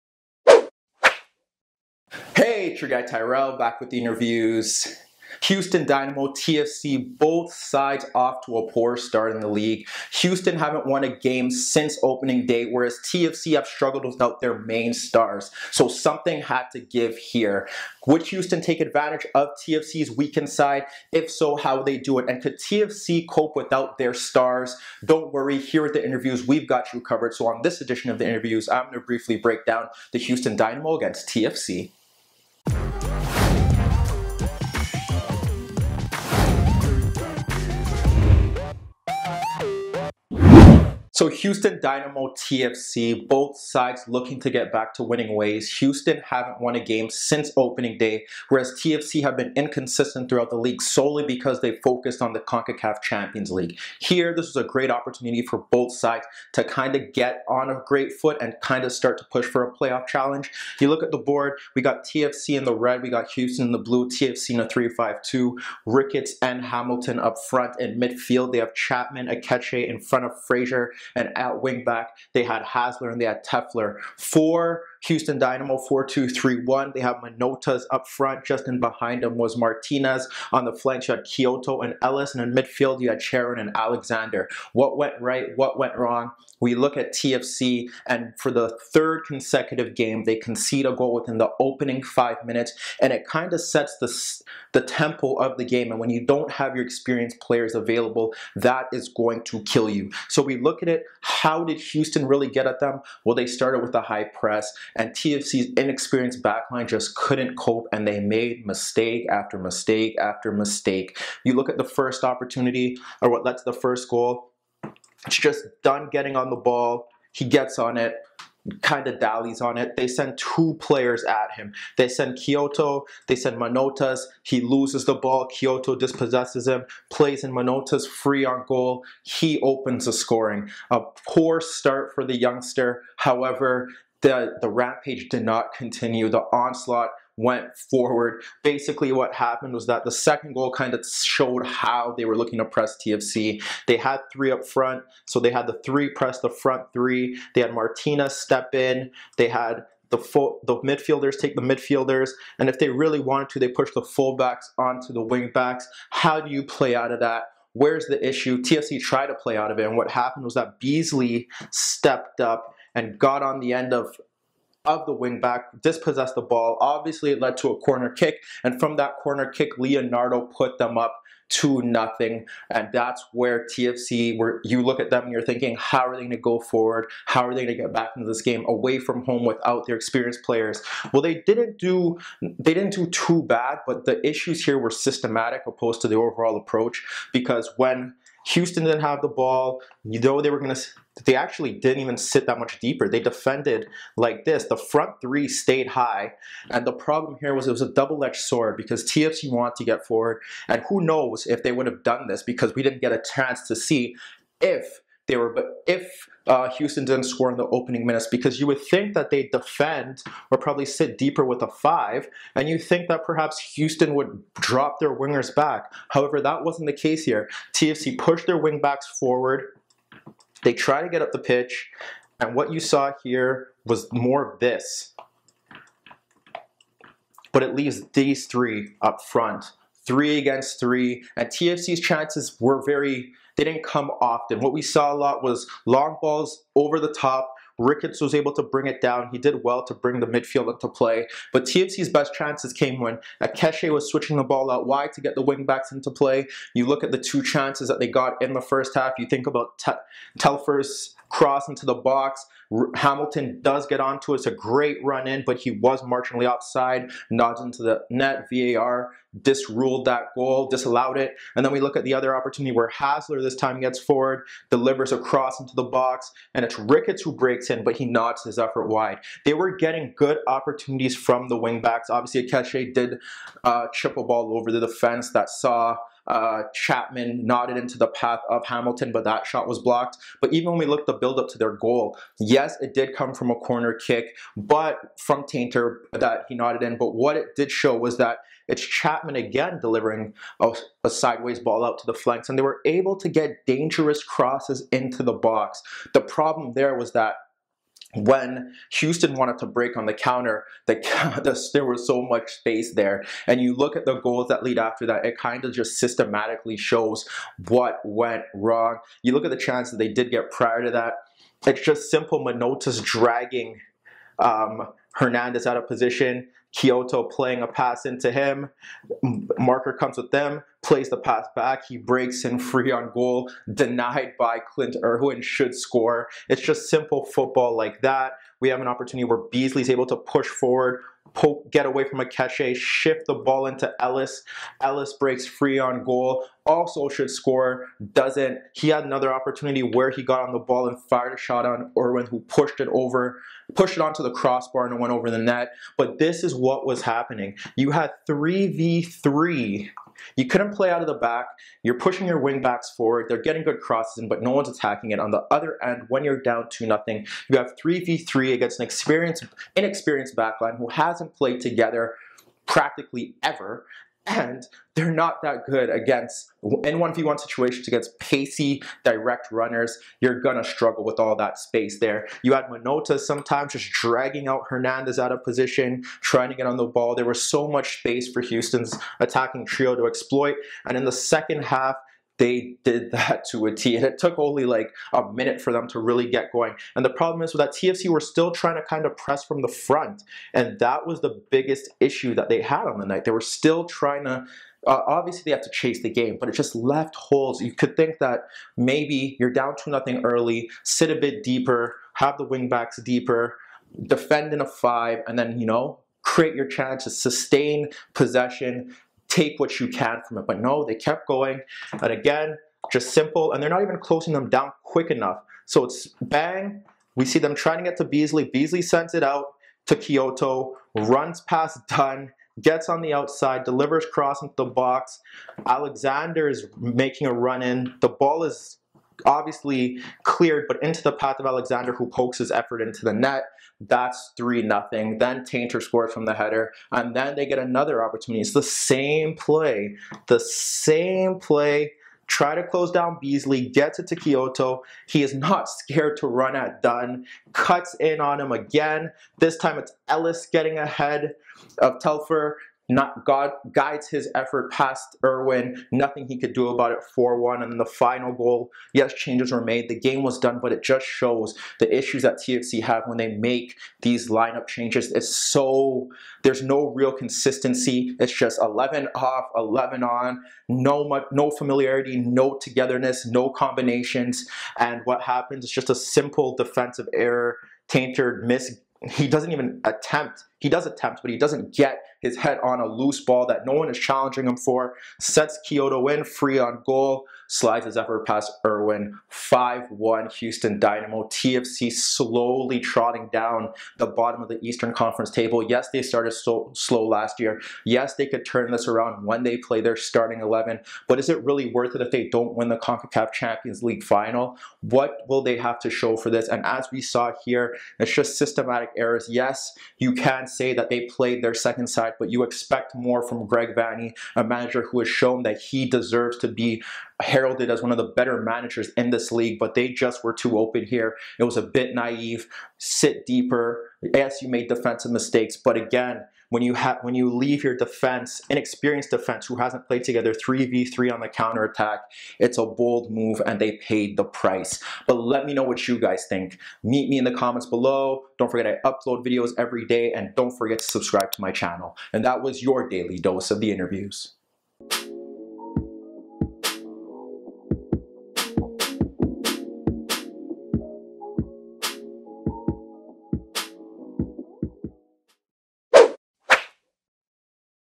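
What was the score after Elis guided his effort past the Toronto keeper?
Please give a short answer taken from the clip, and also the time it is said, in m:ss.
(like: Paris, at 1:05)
4-1, at 7:37.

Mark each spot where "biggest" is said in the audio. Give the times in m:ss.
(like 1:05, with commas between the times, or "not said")
6:31.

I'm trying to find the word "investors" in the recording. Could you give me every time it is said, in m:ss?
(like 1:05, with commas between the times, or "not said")
not said.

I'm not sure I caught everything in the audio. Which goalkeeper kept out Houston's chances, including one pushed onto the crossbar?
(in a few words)
Clint Irwin.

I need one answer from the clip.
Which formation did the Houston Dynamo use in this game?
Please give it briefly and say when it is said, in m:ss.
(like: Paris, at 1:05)
4-2-3-1, at 1:15.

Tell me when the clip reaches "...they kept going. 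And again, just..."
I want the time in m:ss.
6:50.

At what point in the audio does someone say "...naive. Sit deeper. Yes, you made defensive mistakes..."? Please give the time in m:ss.
8:41.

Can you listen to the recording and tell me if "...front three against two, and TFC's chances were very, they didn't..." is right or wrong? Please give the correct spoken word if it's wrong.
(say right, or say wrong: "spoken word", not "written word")
wrong: "three", not "two".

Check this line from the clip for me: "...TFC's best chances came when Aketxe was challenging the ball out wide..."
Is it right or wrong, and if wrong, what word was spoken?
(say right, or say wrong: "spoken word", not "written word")
wrong: "switching", not "challenging".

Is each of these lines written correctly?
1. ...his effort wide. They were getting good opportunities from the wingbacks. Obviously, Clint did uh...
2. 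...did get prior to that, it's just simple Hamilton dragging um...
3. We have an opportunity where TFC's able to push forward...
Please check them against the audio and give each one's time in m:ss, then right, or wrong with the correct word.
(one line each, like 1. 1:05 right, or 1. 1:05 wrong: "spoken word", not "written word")
1. 4:28 wrong: "Aketxe", not "Clint"
2. 5:10 wrong: "Manotas", not "Hamilton"
3. 5:28 wrong: "Beasley", not "TFC".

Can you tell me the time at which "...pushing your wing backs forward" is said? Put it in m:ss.
5:51.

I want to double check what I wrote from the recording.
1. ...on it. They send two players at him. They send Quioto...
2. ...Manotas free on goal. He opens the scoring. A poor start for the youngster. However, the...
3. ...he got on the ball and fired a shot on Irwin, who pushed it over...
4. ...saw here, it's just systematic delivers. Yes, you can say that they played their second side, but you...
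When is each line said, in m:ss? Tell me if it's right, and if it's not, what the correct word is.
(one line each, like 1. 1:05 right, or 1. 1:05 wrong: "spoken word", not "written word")
1. 1:59 right
2. 2:07 right
3. 5:40 right
4. 8:27 wrong: "errors", not "delivers".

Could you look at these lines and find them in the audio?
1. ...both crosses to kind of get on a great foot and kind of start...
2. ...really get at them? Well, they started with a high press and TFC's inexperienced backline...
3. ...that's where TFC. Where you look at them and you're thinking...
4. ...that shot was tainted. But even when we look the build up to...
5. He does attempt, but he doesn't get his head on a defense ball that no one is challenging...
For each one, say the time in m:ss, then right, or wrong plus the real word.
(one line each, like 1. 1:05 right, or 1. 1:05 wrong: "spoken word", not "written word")
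1. 0:55 wrong: "sides", not "crosses"
2. 1:42 right
3. 2:52 right
4. 4:39 wrong: "blocked", not "tainted"
5. 8:00 wrong: "loose", not "defense".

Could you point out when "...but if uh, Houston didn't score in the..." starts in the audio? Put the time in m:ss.
3:25.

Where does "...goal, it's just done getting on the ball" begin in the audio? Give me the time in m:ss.
1:54.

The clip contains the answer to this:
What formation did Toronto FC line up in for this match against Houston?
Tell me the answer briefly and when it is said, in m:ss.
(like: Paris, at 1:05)
3-5-2, at 1:04.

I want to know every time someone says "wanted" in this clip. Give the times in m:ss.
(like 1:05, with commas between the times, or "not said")
2:33, 3:19, 4:59.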